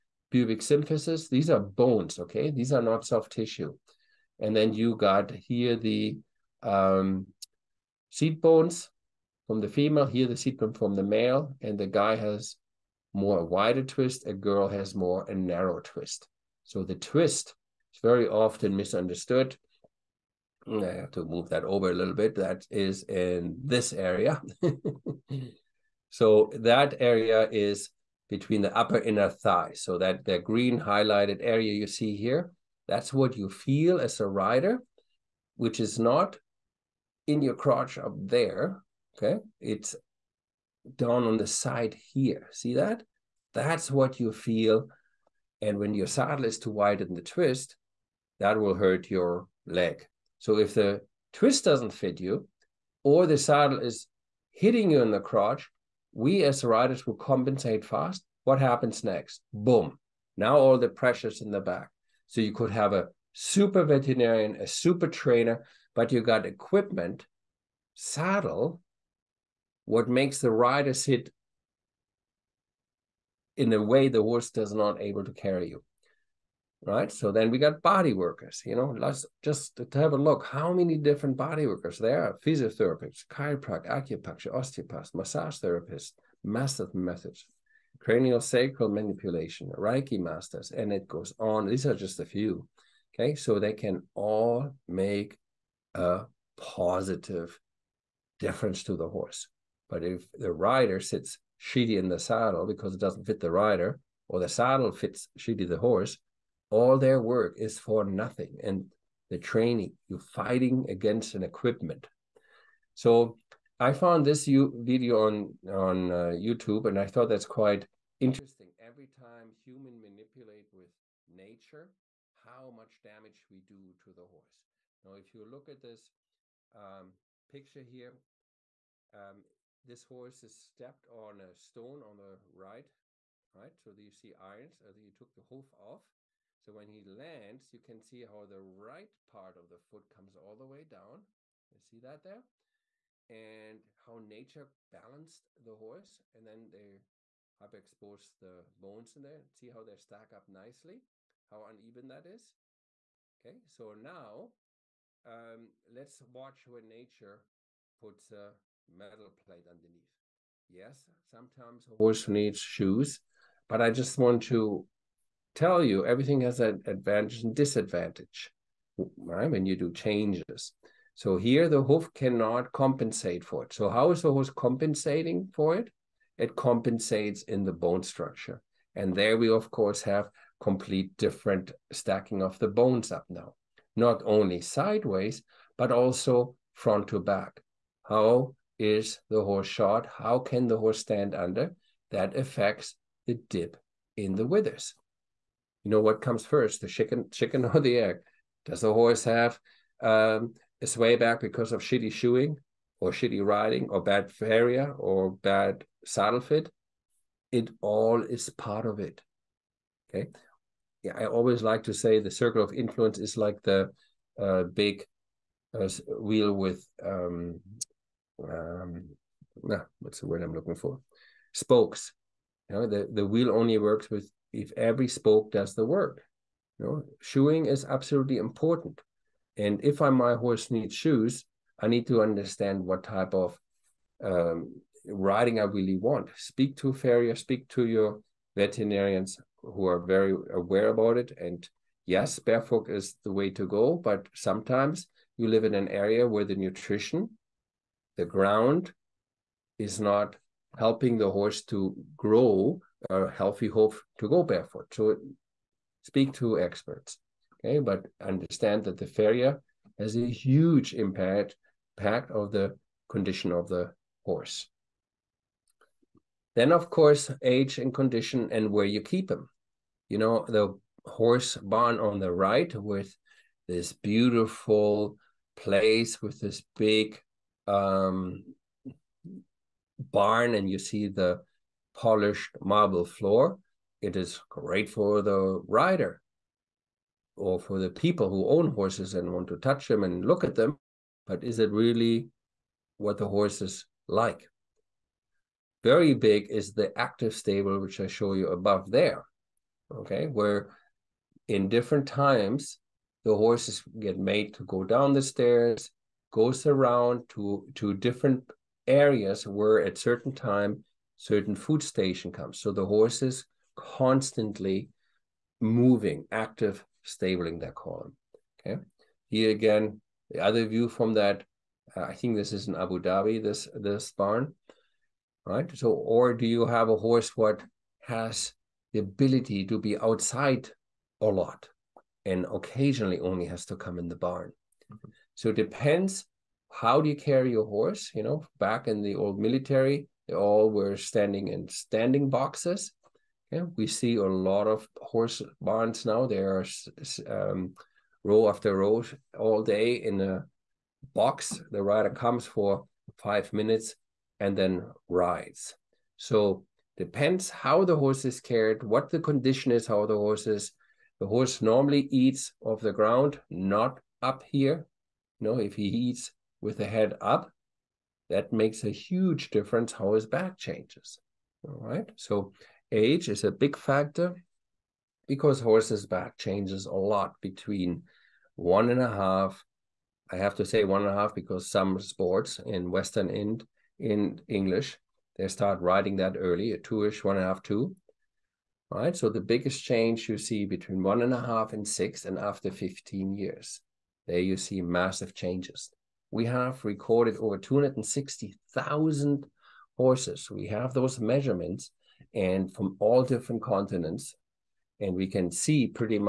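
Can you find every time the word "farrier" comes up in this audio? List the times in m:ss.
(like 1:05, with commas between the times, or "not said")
3:56, 4:19.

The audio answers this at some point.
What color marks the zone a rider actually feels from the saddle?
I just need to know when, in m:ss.
0:30.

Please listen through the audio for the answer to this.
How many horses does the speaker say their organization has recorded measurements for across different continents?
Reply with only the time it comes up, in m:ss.
6:37.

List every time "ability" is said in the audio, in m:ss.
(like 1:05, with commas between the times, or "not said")
5:29.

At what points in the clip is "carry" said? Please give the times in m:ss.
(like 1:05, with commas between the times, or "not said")
1:15, 5:37.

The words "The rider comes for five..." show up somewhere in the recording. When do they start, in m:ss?
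5:51.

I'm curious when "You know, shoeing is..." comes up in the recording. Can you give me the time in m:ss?
3:46.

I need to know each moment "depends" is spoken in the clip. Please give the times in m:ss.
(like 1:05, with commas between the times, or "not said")
5:35, 5:56.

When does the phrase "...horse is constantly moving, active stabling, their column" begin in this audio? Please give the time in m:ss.
5:12.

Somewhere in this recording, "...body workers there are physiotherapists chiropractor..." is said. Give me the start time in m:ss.
1:21.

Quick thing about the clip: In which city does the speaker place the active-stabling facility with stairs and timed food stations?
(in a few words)
Abu Dhabi.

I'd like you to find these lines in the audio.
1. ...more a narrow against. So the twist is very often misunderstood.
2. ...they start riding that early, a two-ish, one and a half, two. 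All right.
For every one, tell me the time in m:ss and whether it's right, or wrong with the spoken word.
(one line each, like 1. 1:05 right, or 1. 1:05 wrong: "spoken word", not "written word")
1. 0:14 wrong: "twist", not "against"
2. 6:25 right.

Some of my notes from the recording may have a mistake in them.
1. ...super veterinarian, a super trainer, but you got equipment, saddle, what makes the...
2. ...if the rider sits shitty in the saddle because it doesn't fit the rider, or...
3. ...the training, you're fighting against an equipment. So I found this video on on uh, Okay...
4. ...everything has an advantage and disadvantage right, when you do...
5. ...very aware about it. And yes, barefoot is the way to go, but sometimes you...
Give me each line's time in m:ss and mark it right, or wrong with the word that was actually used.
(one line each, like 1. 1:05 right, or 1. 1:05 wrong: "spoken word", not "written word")
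1. 1:03 right
2. 1:40 right
3. 1:49 wrong: "YouTube", not "Okay"
4. 2:46 right
5. 3:59 right.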